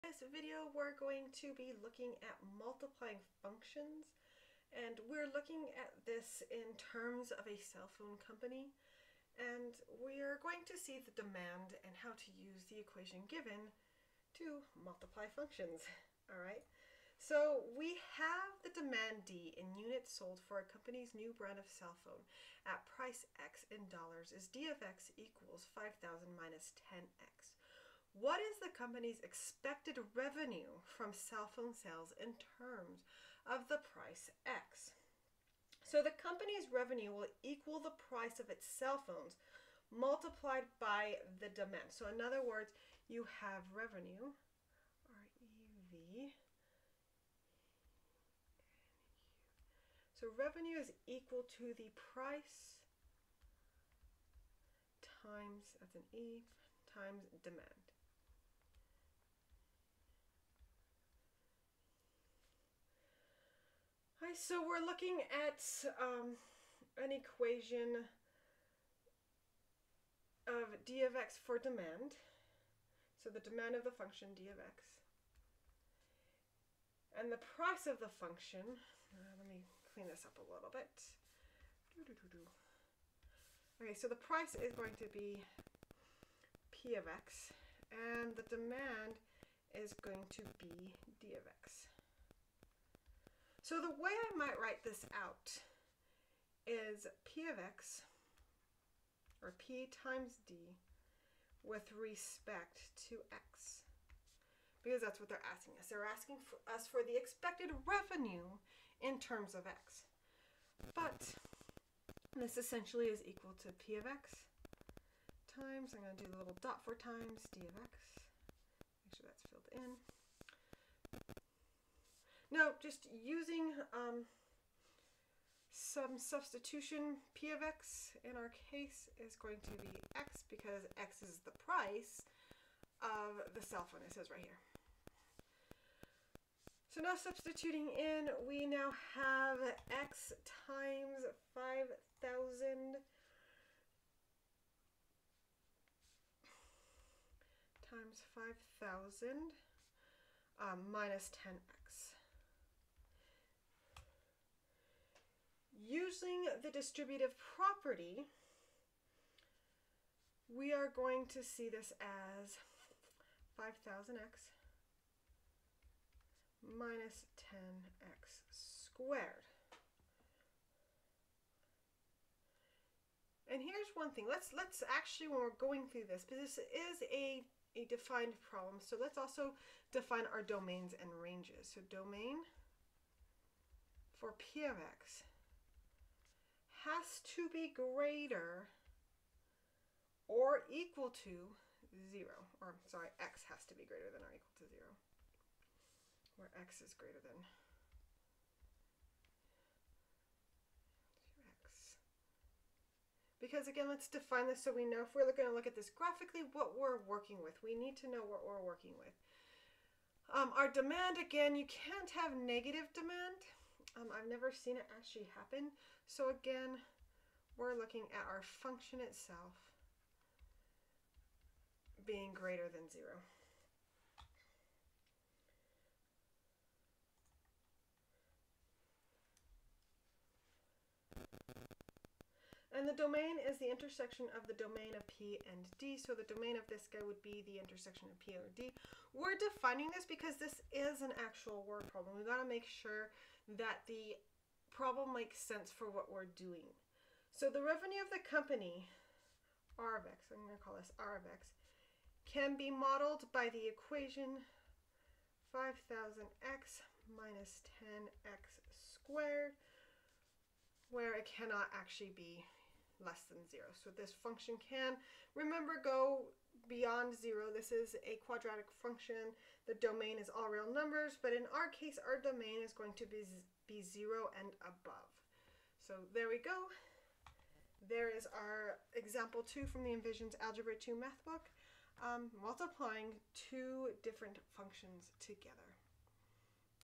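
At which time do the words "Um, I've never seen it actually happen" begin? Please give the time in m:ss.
3:33.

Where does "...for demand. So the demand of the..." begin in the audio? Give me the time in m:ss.
1:11.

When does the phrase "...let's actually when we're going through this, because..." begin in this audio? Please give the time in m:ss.
2:54.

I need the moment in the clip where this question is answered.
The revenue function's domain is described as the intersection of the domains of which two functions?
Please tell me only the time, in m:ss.
3:55.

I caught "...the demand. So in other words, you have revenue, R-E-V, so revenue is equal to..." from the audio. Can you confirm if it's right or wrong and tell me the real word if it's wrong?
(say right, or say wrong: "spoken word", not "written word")
right.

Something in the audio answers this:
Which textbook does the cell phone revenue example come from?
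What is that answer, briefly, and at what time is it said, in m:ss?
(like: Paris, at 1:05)
Envisions Algebra 2, at 4:39.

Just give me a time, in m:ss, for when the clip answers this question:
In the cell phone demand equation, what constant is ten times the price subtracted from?
0:25.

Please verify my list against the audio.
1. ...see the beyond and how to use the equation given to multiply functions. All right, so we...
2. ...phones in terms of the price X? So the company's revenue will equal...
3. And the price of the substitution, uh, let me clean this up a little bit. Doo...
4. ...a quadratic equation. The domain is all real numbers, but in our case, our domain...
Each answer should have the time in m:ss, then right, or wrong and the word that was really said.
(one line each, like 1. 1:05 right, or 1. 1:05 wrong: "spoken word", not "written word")
1. 0:10 wrong: "demand", not "beyond"
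2. 0:31 wrong: "sales", not "phones"
3. 1:17 wrong: "function", not "substitution"
4. 4:28 wrong: "function", not "equation".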